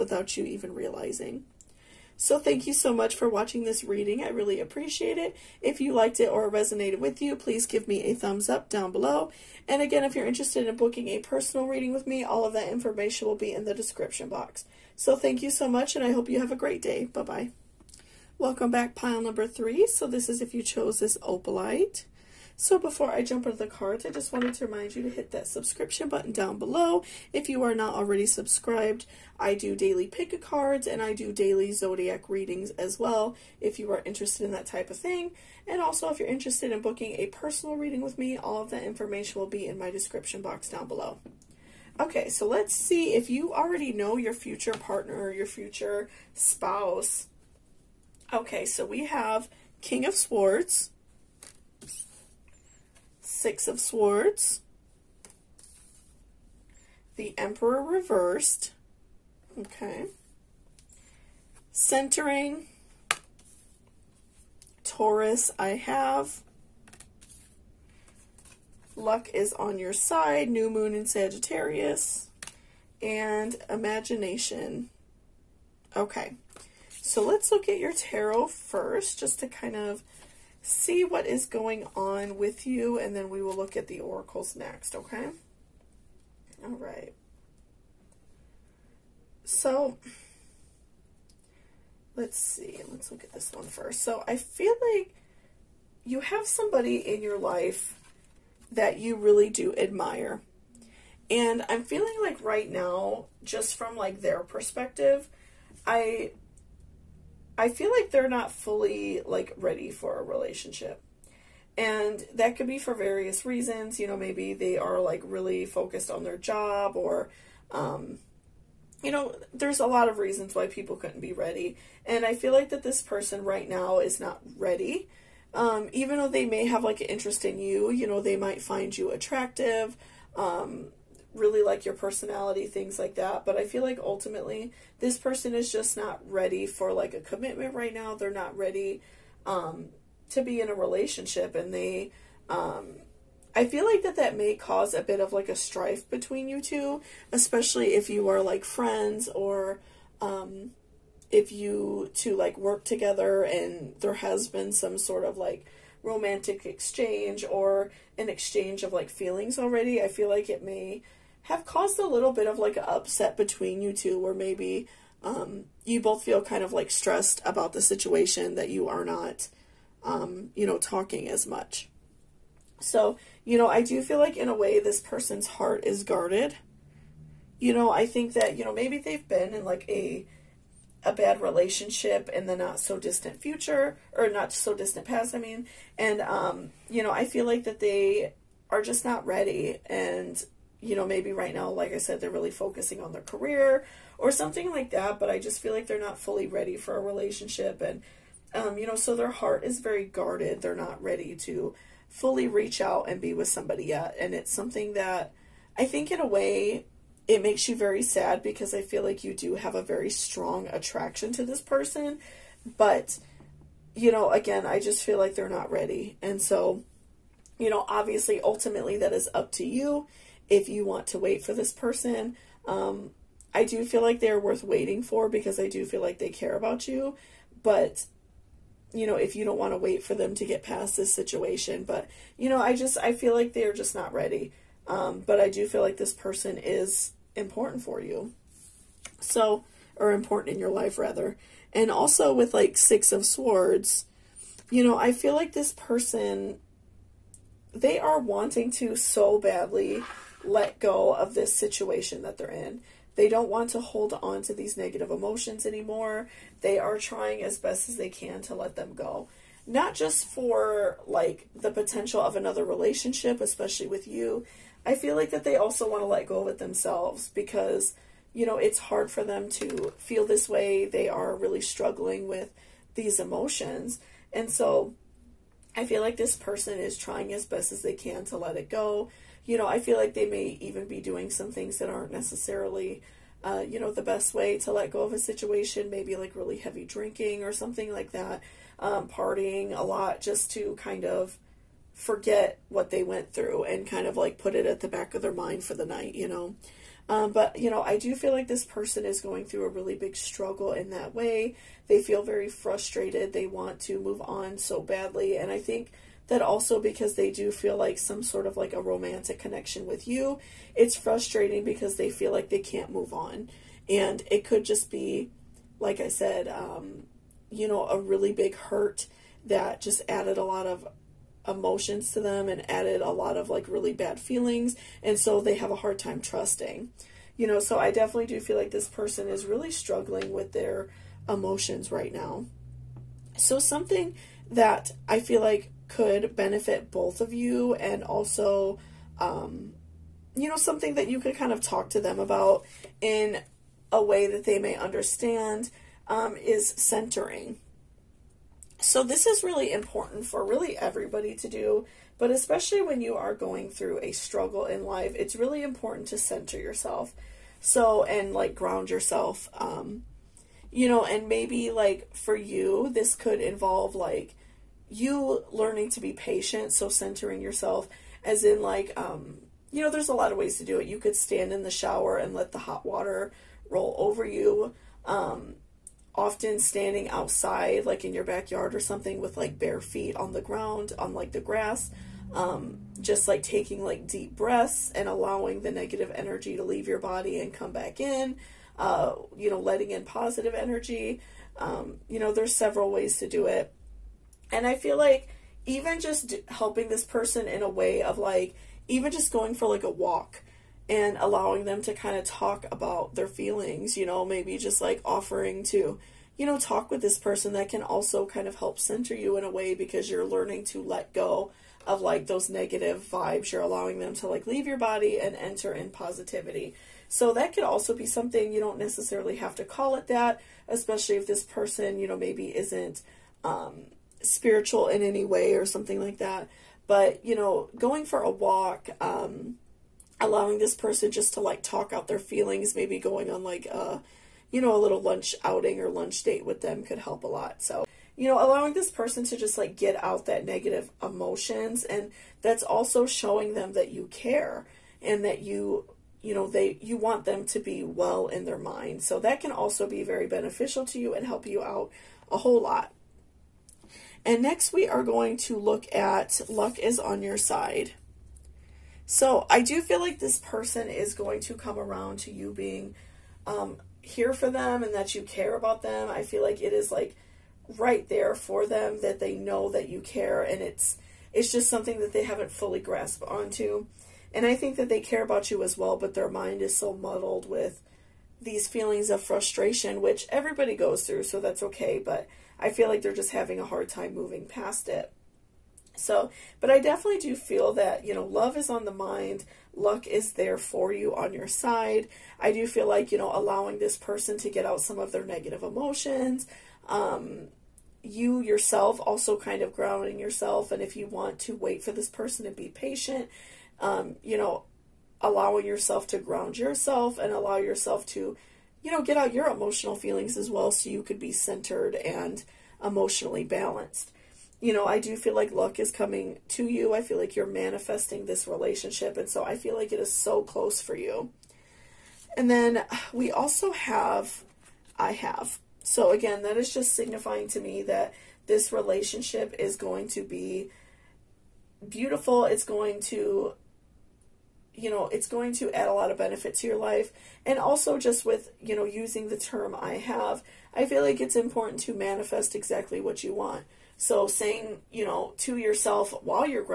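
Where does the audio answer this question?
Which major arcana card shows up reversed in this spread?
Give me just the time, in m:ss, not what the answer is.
0:57.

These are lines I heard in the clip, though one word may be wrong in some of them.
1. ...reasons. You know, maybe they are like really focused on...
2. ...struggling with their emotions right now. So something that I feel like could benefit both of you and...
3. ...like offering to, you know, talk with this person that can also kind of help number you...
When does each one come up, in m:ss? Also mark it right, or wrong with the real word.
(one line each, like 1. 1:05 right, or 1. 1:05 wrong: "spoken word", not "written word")
1. 1:53 right
2. 5:29 right
3. 6:44 wrong: "center", not "number".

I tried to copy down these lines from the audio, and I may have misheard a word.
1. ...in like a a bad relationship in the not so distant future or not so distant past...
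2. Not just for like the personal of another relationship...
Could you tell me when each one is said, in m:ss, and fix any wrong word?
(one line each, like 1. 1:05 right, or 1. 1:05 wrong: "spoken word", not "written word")
1. 2:59 right
2. 4:19 wrong: "potential", not "personal".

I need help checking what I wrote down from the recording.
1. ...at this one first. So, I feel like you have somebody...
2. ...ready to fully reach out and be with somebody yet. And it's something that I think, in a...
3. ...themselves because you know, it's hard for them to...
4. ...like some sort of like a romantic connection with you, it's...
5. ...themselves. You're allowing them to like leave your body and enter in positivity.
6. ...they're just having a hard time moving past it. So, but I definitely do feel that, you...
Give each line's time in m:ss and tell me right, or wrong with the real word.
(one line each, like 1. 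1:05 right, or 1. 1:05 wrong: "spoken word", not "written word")
1. 1:33 right
2. 3:21 right
3. 4:26 right
4. 5:07 right
5. 6:53 wrong: "vibes", not "themselves"
6. 8:03 right.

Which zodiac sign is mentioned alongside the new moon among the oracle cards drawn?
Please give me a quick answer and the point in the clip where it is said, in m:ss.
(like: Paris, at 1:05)
Sagittarius, at 1:10.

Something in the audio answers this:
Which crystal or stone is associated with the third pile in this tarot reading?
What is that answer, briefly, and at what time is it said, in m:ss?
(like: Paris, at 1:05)
Opalite, at 0:21.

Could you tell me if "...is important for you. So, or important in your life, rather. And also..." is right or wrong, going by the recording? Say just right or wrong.
right.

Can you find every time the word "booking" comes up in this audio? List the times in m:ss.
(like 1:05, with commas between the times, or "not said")
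0:10, 0:36.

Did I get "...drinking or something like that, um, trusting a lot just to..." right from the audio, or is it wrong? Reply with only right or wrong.
wrong.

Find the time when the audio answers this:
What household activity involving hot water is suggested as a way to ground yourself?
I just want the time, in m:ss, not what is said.
6:11.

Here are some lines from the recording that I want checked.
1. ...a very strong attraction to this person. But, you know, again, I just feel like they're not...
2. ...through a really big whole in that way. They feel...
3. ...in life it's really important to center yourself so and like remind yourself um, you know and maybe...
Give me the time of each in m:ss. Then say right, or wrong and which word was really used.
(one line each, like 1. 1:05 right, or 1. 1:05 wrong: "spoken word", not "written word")
1. 3:29 right
2. 4:59 wrong: "struggle", not "whole"
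3. 5:54 wrong: "ground", not "remind".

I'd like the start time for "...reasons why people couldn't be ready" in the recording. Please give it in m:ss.
2:00.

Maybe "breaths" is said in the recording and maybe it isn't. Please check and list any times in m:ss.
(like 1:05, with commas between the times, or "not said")
6:24.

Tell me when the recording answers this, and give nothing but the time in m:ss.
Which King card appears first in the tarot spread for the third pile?
0:49.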